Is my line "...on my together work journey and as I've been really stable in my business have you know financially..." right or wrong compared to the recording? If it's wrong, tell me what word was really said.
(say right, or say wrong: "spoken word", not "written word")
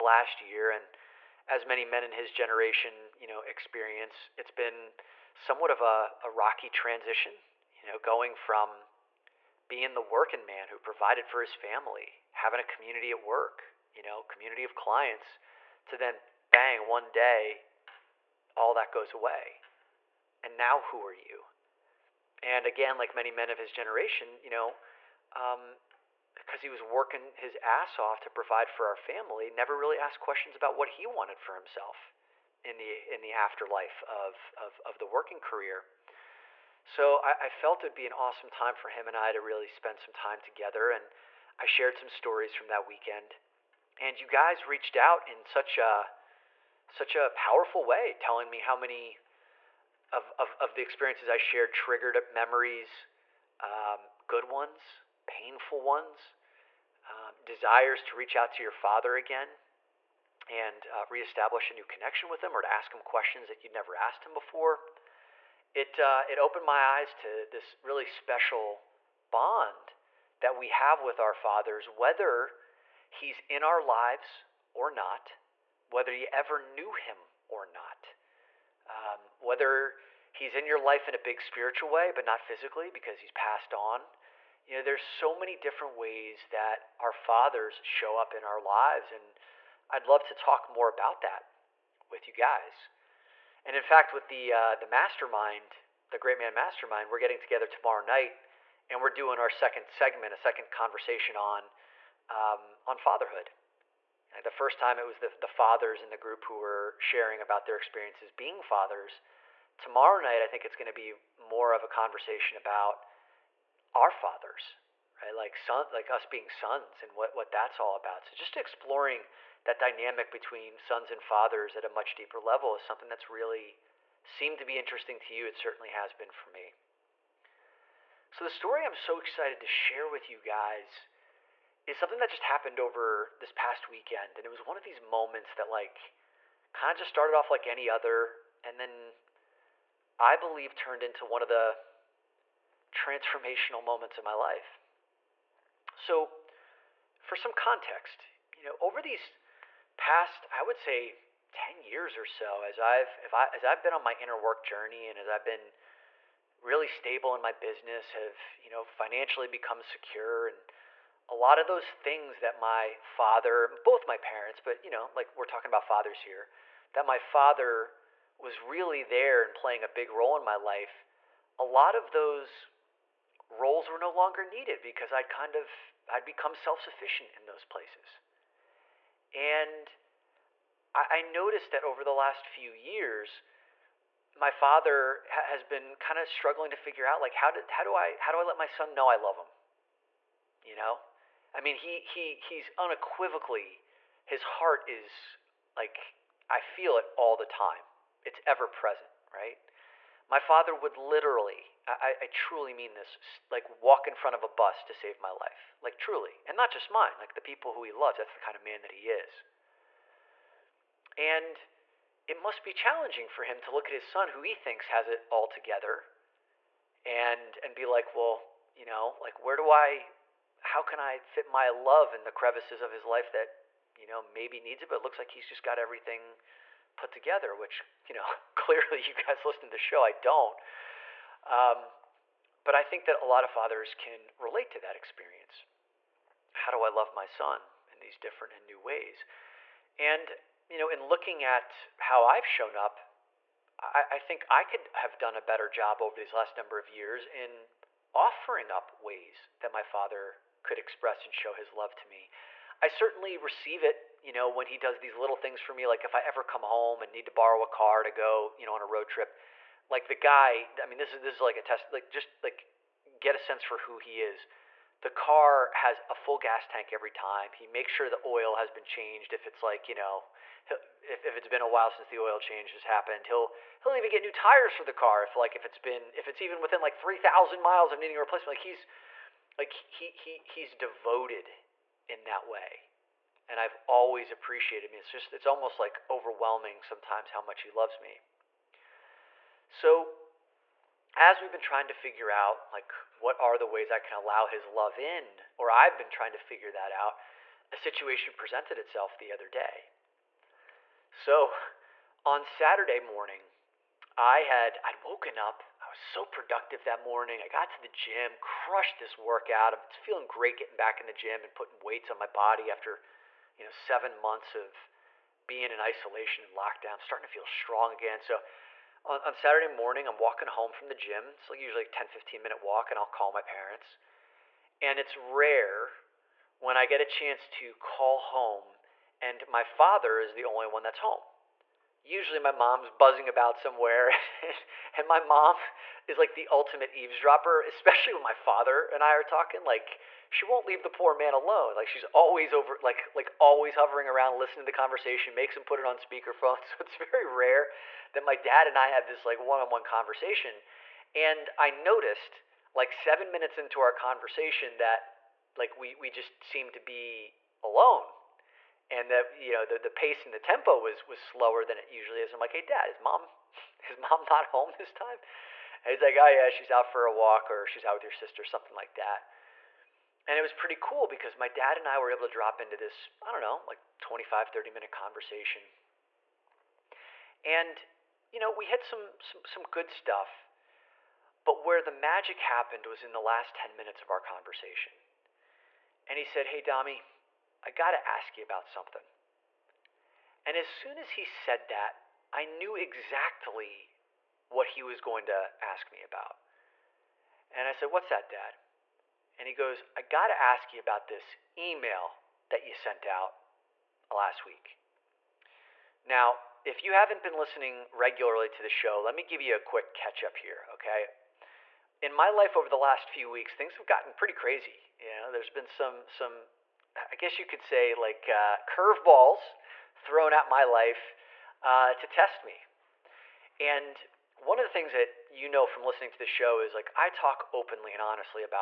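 wrong: "inner", not "together".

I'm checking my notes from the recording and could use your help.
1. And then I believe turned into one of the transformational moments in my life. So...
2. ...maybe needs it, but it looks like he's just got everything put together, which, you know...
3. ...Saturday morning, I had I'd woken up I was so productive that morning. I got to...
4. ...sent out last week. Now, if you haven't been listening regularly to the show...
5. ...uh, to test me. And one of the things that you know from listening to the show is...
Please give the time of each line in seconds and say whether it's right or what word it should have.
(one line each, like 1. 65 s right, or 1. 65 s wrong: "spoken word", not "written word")
1. 138 s right
2. 224 s right
3. 302 s right
4. 402 s right
5. 421 s right.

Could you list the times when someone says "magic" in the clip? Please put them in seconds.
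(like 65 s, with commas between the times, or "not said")
381 s.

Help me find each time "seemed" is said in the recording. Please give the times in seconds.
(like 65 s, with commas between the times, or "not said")
124 s, 356 s.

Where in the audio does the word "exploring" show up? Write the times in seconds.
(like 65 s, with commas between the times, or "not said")
118 s.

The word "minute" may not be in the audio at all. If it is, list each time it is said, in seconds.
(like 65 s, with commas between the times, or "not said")
322 s, 353 s, 374 s, 383 s.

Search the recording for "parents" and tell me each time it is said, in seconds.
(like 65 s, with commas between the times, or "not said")
164 s, 323 s.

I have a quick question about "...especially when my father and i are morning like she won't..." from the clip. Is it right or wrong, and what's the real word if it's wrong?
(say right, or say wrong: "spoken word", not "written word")
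wrong: "talking", not "morning".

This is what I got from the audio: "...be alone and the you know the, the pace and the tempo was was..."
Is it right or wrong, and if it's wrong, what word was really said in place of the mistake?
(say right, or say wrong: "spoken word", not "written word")
right.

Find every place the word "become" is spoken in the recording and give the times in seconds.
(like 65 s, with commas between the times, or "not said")
159 s, 176 s.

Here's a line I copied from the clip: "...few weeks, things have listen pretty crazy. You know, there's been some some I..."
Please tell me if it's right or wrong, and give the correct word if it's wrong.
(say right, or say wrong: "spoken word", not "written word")
wrong: "gotten", not "listen".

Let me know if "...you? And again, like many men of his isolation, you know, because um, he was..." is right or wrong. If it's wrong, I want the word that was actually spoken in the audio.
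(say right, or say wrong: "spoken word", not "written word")
wrong: "generation", not "isolation".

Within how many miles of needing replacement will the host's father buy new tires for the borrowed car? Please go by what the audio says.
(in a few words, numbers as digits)
3000.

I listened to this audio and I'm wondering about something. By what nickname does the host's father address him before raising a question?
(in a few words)
Dami.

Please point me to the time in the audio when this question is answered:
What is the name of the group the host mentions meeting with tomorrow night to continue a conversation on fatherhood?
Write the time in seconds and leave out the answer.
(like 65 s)
96 s.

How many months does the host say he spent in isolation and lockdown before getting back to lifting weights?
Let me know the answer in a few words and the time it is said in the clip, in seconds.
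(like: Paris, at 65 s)
7, at 313 s.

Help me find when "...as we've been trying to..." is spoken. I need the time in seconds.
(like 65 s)
291 s.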